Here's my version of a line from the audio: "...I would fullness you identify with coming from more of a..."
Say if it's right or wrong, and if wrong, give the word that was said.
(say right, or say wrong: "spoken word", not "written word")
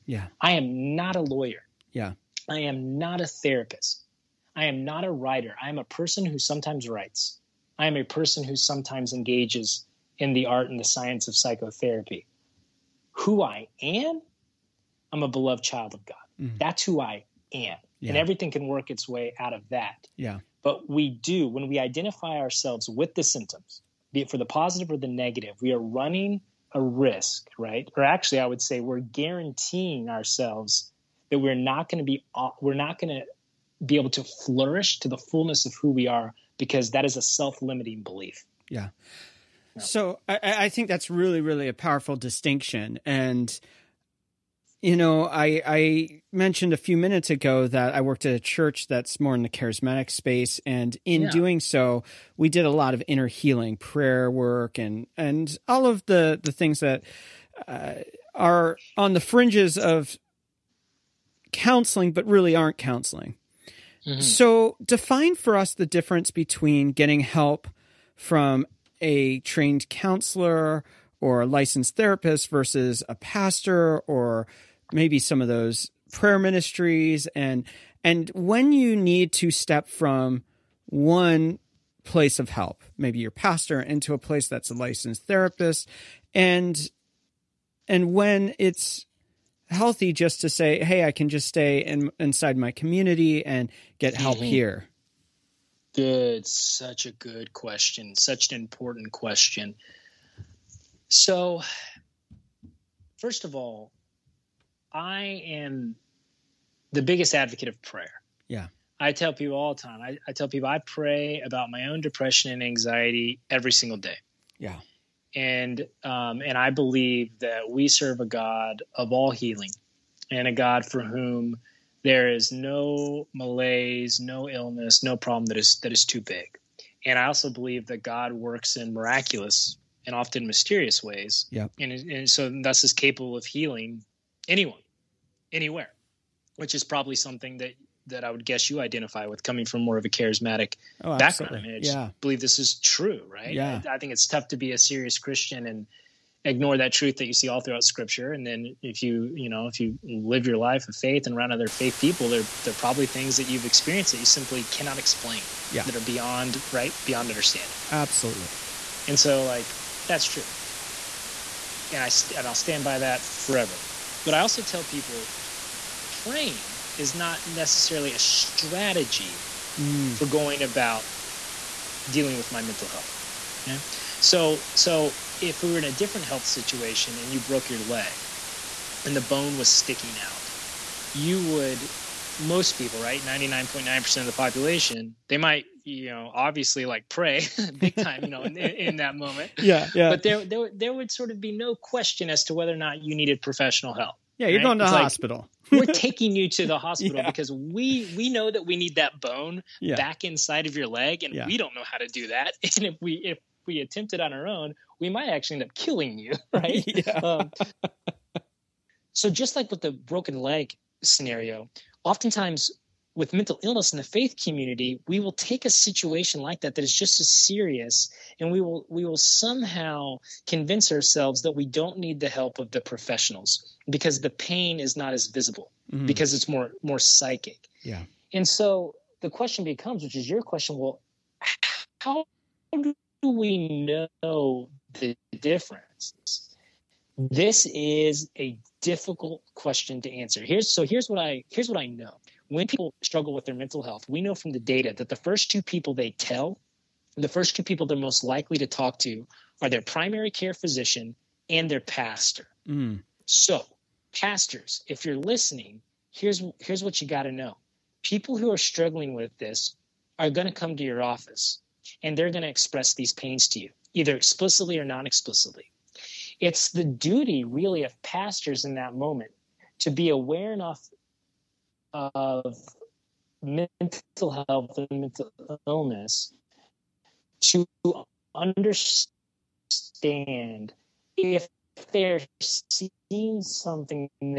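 wrong: "guess", not "fullness".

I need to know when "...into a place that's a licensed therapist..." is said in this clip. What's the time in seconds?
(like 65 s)
83 s.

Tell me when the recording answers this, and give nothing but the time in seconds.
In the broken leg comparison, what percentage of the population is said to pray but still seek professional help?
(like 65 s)
183 s.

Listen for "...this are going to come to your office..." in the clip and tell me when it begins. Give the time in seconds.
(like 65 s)
259 s.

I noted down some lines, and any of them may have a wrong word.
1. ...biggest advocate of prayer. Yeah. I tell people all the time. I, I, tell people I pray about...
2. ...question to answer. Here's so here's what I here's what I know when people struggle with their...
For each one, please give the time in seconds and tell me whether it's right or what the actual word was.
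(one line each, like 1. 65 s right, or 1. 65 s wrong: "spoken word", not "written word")
1. 107 s right
2. 239 s right.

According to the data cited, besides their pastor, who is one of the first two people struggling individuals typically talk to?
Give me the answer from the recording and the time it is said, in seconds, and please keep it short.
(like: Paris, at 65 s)
primary care physician, at 249 s.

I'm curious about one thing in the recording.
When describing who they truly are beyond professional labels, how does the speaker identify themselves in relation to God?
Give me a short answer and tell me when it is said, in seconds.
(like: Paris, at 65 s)
beloved child of God, at 15 s.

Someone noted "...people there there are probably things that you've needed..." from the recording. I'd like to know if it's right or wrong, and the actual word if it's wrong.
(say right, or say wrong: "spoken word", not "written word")
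wrong: "experienced", not "needed".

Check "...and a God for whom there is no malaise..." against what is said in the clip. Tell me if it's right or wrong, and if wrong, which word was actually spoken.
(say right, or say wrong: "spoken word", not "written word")
right.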